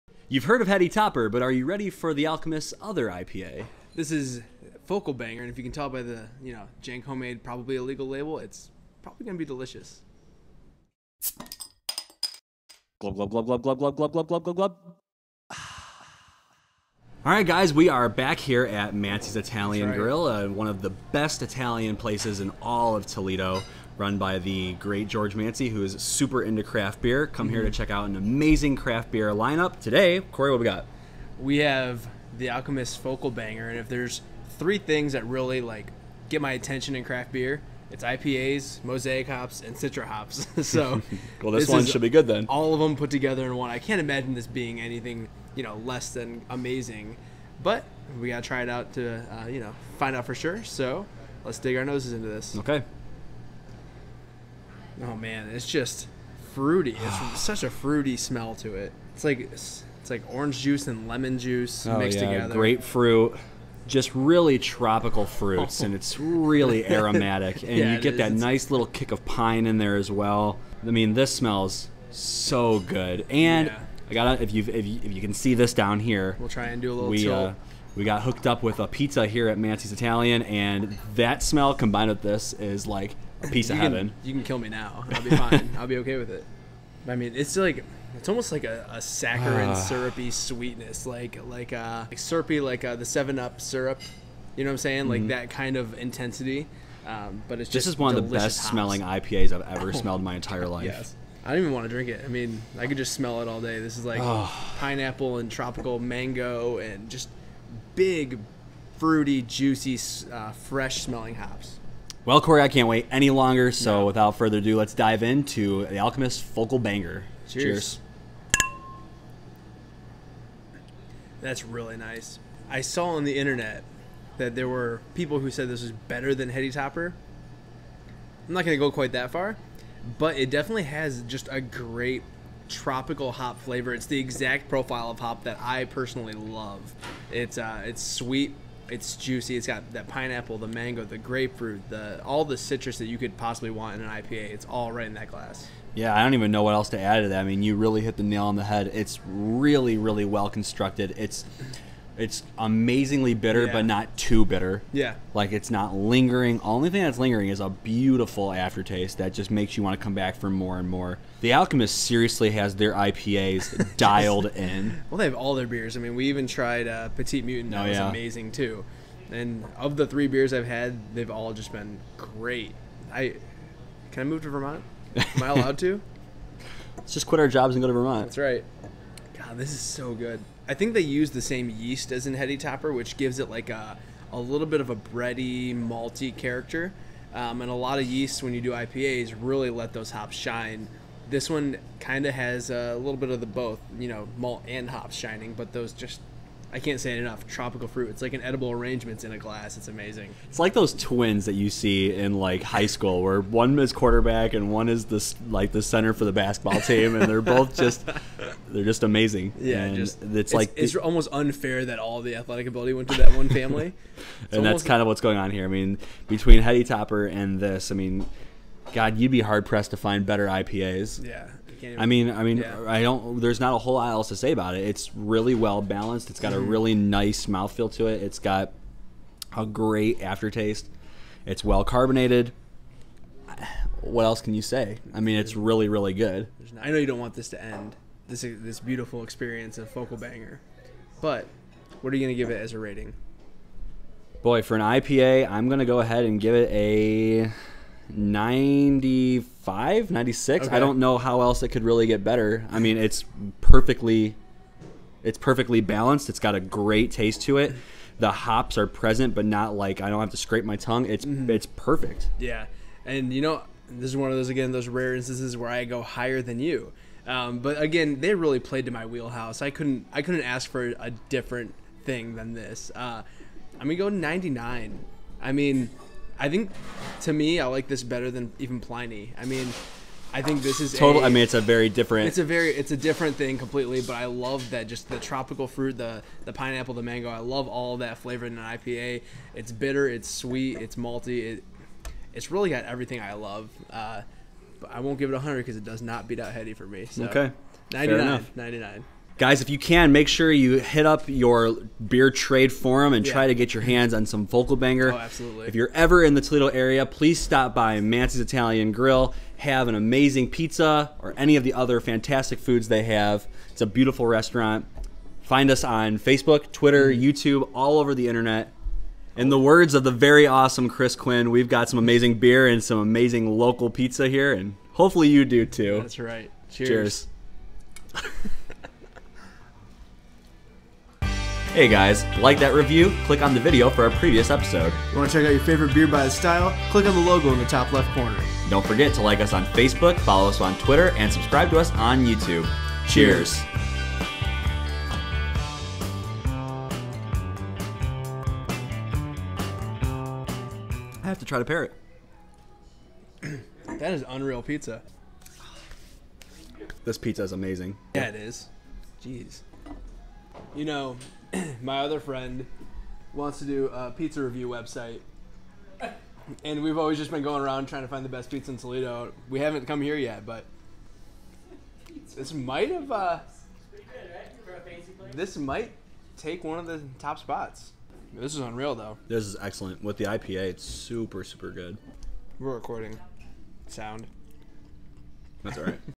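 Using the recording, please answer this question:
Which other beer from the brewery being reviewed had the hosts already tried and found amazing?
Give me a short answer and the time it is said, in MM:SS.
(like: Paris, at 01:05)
Petite Mutant, at 02:47.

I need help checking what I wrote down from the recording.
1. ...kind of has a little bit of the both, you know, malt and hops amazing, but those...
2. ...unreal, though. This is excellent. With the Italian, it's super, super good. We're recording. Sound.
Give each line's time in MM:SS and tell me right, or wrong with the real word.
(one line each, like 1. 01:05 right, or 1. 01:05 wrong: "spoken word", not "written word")
1. 03:11 wrong: "shining", not "amazing"
2. 06:18 wrong: "IPA", not "Italian".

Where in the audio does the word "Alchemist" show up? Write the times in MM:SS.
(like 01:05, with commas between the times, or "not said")
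00:02, 00:32, 01:55, 02:41.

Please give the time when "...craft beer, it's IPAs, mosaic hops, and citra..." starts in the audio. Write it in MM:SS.
00:37.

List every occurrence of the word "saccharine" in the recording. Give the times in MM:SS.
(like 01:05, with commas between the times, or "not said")
01:29.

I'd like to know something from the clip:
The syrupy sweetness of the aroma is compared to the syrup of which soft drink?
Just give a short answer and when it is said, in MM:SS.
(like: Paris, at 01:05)
Seven Up, at 01:33.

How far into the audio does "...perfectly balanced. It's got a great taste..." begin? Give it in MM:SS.
04:15.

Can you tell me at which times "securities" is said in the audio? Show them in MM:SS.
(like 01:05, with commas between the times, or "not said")
not said.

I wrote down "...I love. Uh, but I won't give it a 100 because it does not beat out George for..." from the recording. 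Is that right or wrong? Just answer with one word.
wrong.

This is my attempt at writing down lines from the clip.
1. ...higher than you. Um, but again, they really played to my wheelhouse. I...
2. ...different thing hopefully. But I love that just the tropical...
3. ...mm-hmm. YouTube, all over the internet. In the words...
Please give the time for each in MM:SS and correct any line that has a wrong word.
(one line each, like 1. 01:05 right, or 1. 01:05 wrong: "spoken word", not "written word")
1. 04:26 right
2. 04:42 wrong: "completely", not "hopefully"
3. 05:17 right.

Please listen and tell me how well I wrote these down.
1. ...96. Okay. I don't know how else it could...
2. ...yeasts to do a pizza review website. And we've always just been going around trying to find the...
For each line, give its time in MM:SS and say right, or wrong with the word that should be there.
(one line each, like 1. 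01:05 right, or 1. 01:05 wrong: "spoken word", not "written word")
1. 04:10 right
2. 06:03 wrong: "wants", not "yeasts".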